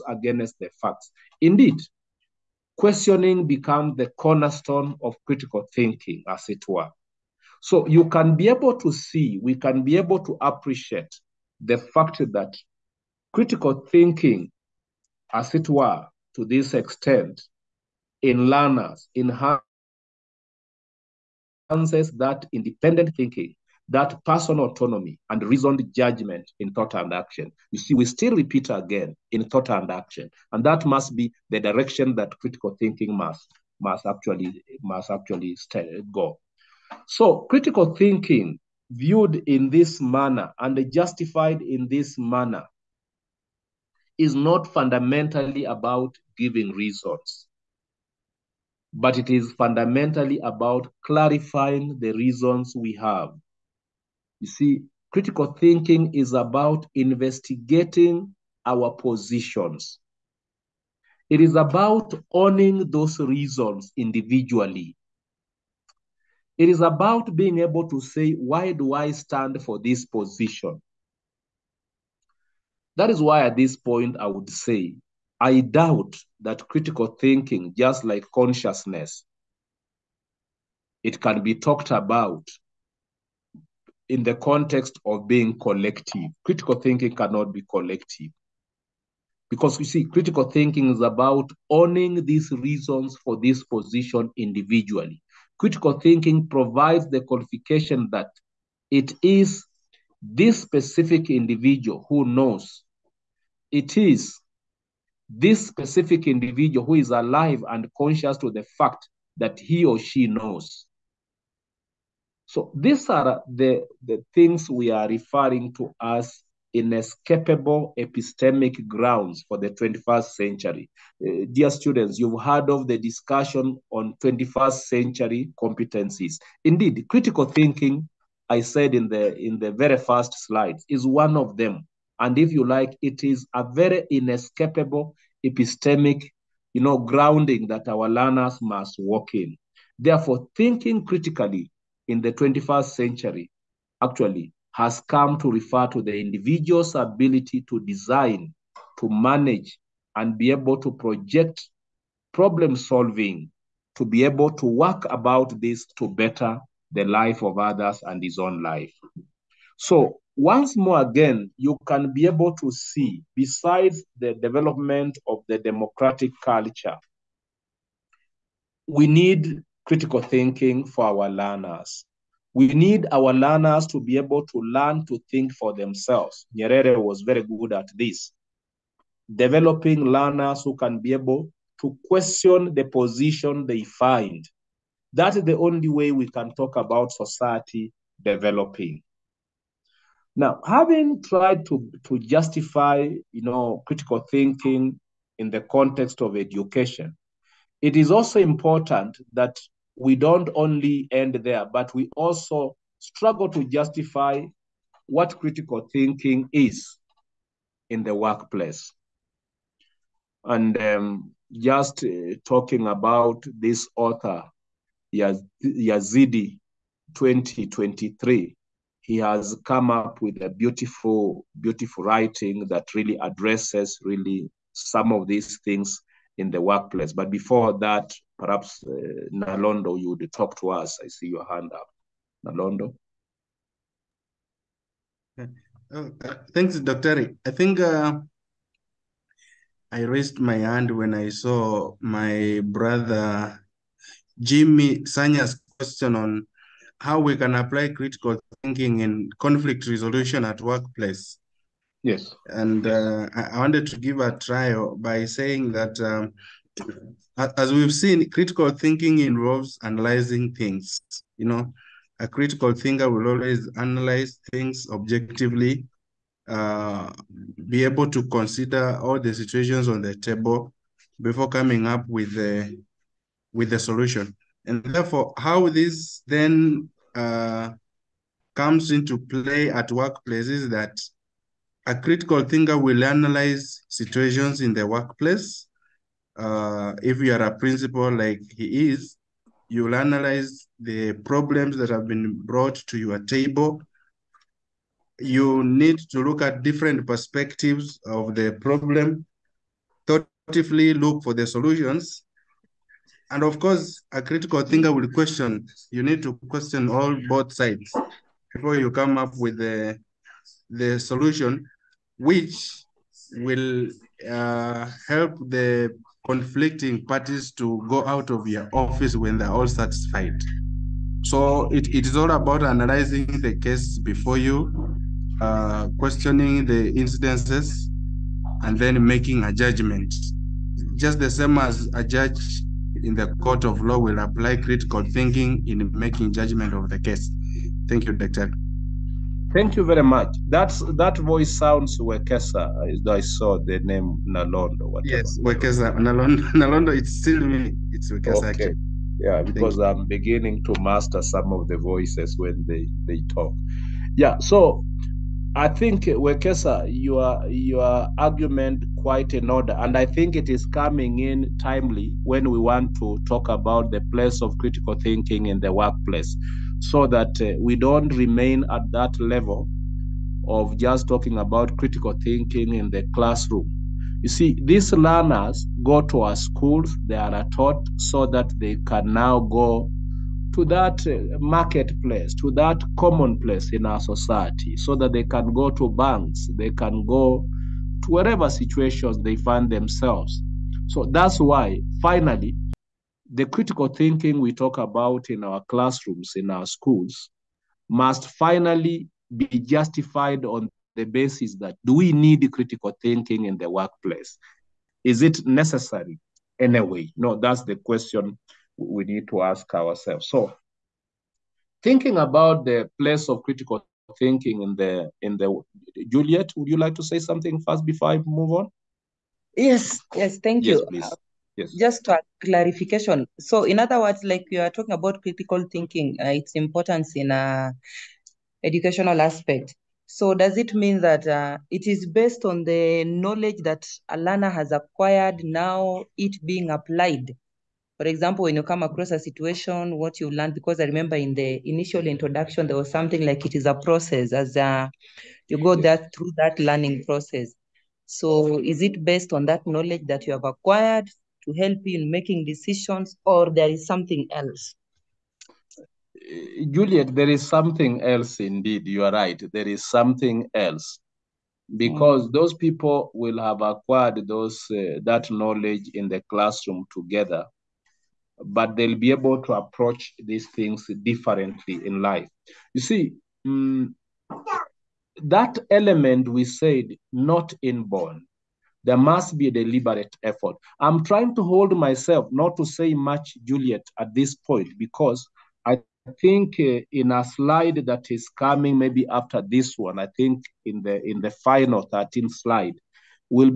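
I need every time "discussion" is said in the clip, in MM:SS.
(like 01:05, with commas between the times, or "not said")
02:02.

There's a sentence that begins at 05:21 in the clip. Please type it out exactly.
So it, it is all about analyzing the case before you, uh, questioning the incidences, and then making a judgment.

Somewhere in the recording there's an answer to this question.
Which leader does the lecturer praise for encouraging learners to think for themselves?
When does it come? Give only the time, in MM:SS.
02:56.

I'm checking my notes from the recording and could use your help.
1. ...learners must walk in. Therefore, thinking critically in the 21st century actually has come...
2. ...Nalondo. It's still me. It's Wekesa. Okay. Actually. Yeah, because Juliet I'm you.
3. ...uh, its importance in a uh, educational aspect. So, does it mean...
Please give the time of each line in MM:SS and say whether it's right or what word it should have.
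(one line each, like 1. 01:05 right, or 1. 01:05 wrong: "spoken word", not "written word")
1. 02:18 right
2. 05:46 wrong: "Thank", not "Juliet"
3. 07:06 right.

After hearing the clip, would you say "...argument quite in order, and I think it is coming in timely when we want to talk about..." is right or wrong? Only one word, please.
right.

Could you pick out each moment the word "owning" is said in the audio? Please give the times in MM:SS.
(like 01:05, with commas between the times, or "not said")
01:02, 01:31.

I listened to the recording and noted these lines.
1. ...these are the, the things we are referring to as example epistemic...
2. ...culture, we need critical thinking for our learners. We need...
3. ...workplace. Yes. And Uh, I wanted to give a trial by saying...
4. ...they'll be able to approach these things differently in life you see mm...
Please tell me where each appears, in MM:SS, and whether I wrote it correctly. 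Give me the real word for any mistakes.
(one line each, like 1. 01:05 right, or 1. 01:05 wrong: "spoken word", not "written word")
1. 01:52 wrong: "inescapable", not "example"
2. 02:46 right
3. 04:10 right
4. 07:48 right.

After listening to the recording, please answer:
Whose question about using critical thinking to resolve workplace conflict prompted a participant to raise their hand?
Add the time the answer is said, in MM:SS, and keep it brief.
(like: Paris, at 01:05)
Jimmy Sanya, at 04:04.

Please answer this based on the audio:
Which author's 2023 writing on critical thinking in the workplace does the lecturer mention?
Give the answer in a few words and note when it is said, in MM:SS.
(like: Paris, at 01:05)
Yazidi, at 03:35.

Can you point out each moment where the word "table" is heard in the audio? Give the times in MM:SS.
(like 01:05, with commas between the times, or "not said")
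04:30, 04:53.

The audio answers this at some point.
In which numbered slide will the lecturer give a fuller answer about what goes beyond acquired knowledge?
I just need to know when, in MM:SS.
08:11.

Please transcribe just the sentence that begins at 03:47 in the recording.
But before that, Perhaps uh, Nalondo, you would talk to us.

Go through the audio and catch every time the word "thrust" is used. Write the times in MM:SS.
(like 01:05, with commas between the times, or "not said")
not said.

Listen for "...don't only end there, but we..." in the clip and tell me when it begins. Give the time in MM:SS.
03:20.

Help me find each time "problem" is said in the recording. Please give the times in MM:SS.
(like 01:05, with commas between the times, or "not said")
02:32, 04:51, 04:58.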